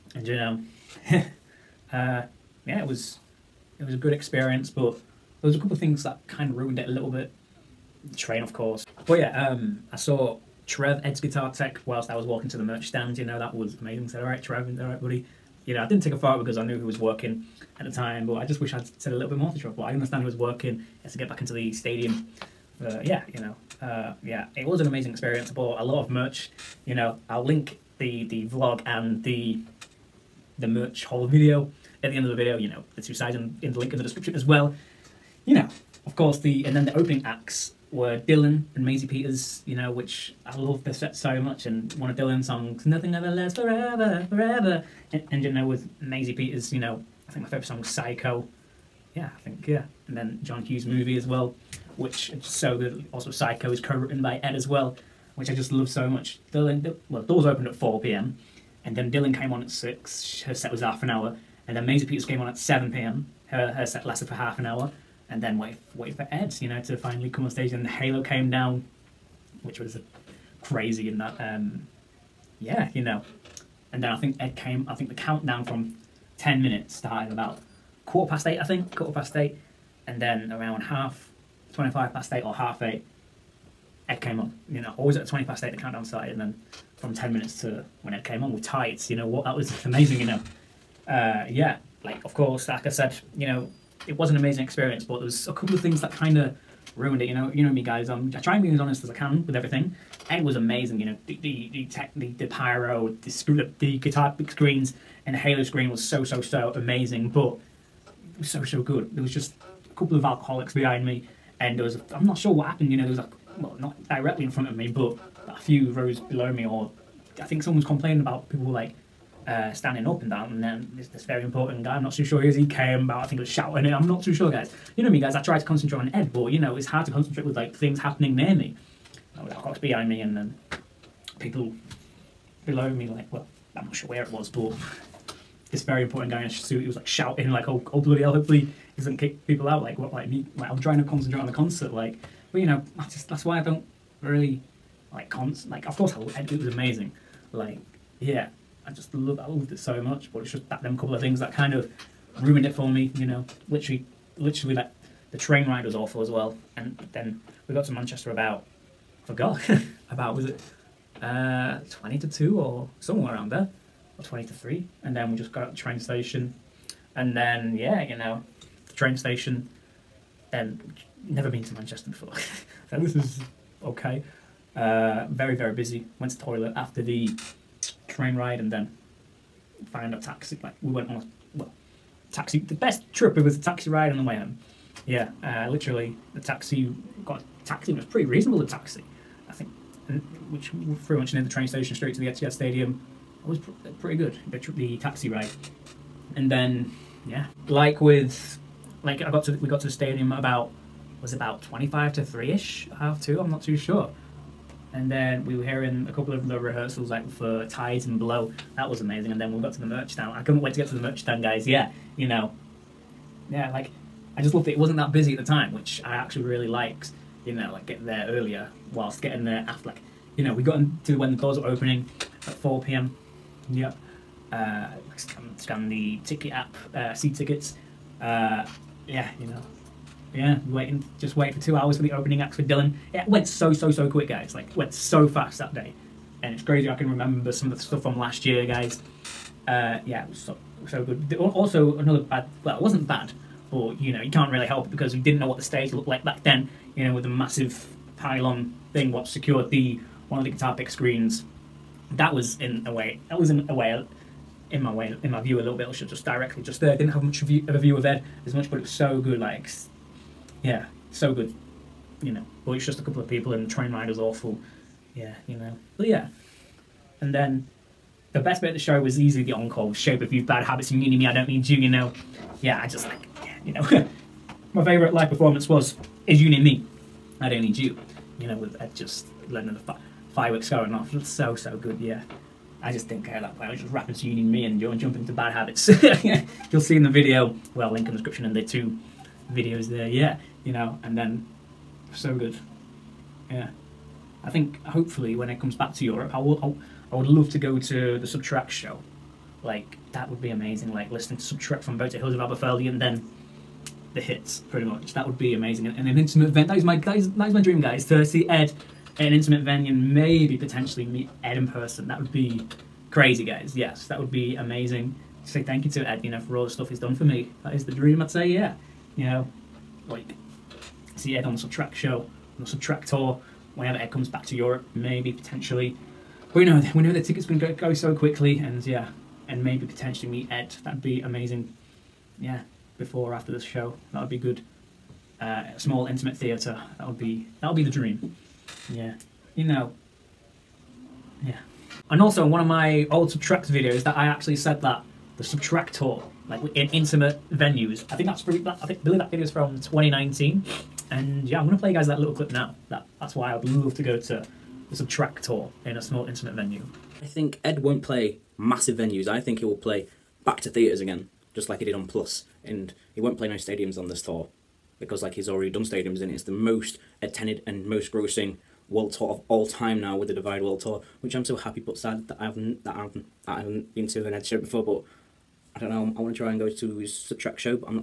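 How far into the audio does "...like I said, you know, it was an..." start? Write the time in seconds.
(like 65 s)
92 s.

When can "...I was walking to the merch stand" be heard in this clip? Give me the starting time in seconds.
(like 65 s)
12 s.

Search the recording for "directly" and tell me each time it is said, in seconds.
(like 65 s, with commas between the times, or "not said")
114 s, 256 s.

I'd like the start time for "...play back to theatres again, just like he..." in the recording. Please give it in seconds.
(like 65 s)
359 s.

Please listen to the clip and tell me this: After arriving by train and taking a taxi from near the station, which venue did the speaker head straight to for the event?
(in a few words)
Etihad Stadium.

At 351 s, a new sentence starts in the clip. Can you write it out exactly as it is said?
And yeah, I'm gonna play you guys that little clip now.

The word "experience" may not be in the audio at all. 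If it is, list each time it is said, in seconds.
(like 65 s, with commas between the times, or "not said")
4 s, 25 s, 94 s.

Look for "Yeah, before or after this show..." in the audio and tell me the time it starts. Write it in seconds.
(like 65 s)
332 s.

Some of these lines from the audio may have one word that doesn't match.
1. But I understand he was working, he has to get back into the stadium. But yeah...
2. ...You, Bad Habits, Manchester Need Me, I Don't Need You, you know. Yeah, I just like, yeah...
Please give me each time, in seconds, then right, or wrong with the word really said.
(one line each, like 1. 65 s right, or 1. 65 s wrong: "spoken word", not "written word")
1. 19 s right
2. 270 s wrong: "You", not "Manchester".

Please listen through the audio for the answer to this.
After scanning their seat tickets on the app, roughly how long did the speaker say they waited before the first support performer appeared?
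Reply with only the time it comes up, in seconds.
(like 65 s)
231 s.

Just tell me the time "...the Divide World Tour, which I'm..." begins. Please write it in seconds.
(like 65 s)
370 s.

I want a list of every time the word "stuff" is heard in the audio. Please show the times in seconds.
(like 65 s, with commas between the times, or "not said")
237 s, 316 s.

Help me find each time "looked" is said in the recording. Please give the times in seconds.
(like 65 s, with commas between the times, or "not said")
245 s.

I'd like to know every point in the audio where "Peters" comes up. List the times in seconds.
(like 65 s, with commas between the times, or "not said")
39 s, 46 s, 62 s.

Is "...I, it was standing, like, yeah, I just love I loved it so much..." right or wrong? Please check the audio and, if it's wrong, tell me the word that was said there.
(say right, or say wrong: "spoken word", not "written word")
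wrong: "amazing", not "standing".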